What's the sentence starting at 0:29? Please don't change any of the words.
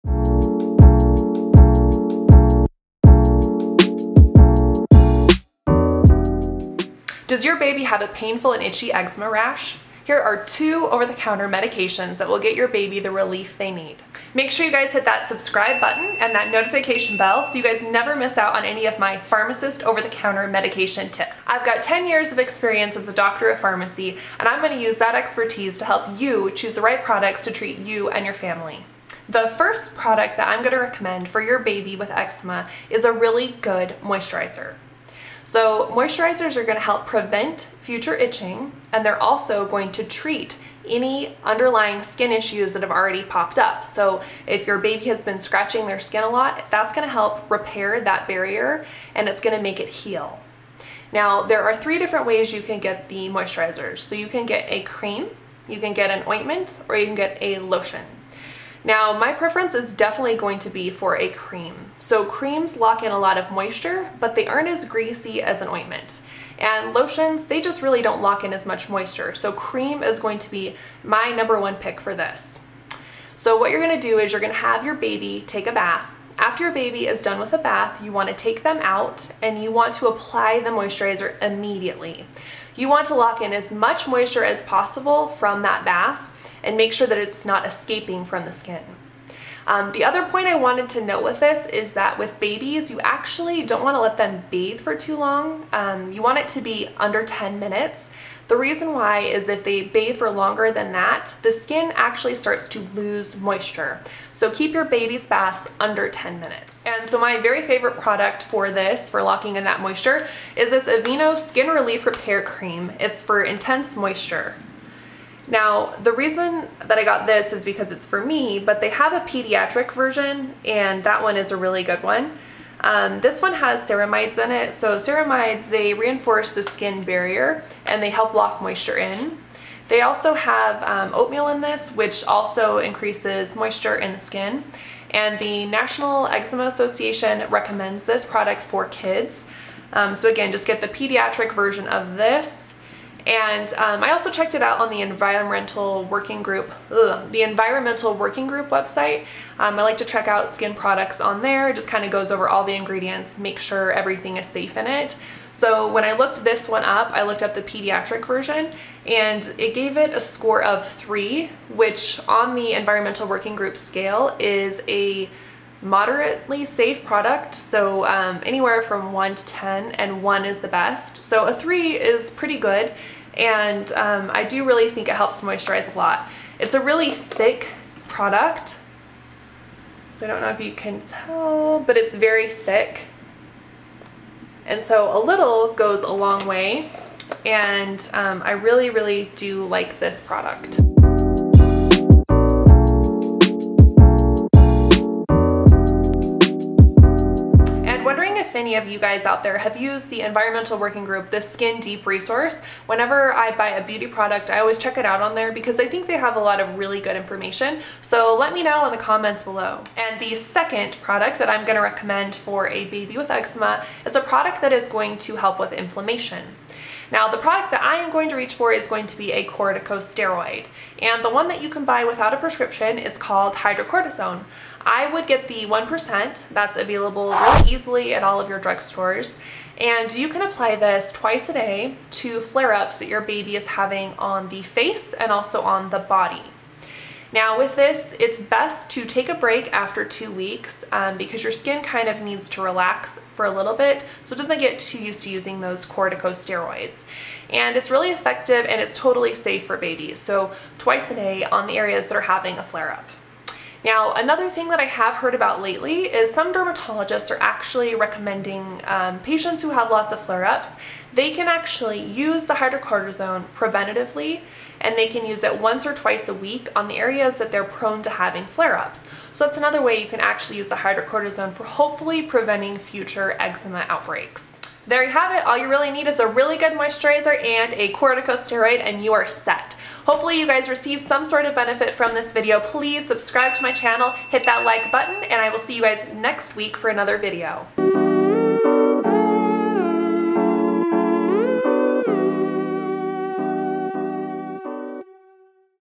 The first product that I'm going to recommend for your baby with eczema is a really good moisturizer.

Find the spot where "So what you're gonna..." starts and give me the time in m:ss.
1:13.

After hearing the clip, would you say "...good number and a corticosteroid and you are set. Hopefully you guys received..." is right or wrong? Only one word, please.
wrong.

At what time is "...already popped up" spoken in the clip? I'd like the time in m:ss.
0:42.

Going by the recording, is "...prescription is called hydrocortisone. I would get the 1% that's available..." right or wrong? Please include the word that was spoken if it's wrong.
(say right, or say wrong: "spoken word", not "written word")
right.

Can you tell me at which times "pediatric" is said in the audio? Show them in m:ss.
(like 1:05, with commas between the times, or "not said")
1:59, 2:20, 2:37.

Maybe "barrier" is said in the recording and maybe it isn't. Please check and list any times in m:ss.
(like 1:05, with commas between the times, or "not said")
0:48, 2:07.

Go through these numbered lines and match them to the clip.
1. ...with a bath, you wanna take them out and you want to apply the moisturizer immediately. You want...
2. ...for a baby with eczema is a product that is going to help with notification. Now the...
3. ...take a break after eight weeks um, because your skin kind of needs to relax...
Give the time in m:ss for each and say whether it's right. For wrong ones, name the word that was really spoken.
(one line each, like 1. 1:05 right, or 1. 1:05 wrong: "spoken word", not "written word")
1. 1:17 right
2. 3:32 wrong: "inflammation", not "notification"
3. 3:59 wrong: "two", not "eight".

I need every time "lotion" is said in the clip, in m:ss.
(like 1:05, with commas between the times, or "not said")
0:57, 1:06.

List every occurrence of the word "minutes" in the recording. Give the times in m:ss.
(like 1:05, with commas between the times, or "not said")
1:37, 1:46.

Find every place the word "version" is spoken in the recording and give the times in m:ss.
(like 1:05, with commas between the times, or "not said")
1:59, 2:21, 2:38.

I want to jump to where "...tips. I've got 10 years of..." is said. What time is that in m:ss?
0:21.